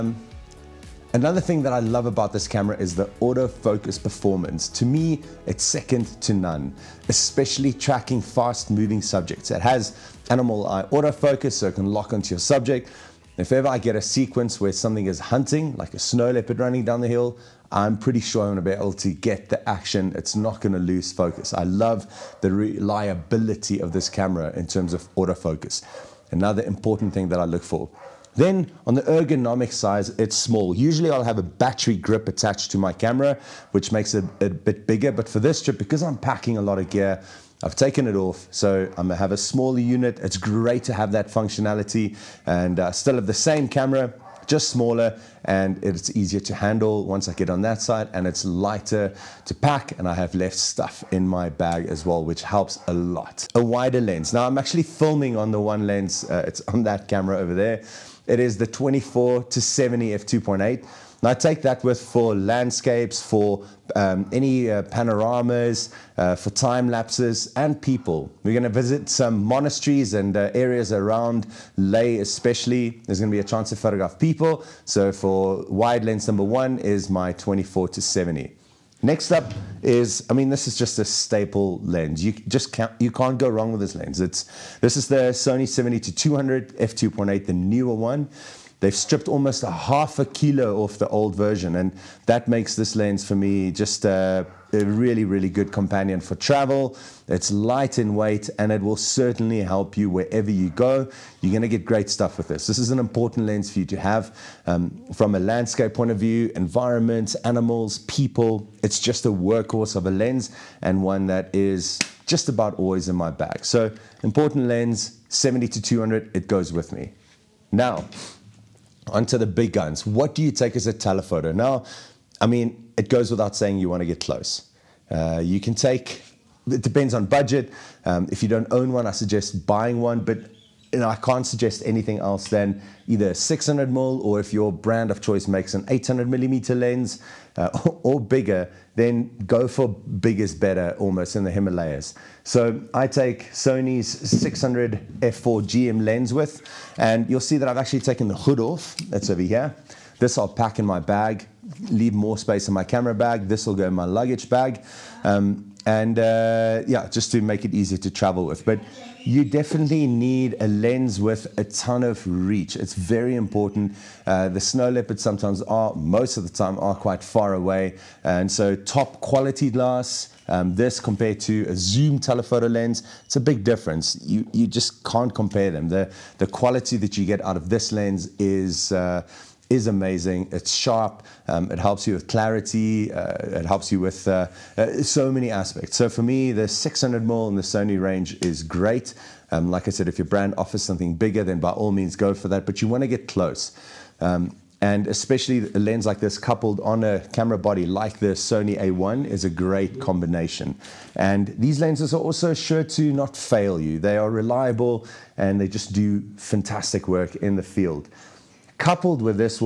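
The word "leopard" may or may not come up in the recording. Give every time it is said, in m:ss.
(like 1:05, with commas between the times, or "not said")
0:16, 2:44.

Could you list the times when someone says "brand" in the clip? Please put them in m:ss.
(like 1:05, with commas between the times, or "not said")
2:14, 3:10.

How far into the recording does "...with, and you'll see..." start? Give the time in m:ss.
2:26.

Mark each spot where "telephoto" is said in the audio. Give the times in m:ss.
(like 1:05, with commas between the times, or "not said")
2:00, 2:52.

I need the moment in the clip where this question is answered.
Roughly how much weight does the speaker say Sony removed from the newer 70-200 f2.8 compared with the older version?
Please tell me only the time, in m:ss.
1:29.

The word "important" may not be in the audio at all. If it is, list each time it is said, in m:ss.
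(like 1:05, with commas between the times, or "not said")
0:26, 1:42, 1:54, 2:43.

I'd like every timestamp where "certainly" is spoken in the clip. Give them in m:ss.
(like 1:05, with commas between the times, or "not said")
1:38.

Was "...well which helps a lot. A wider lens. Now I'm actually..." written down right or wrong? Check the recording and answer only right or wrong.
right.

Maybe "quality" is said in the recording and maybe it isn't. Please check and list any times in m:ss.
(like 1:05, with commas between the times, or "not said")
2:49, 2:56.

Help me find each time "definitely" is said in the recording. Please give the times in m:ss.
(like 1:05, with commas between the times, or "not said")
2:39.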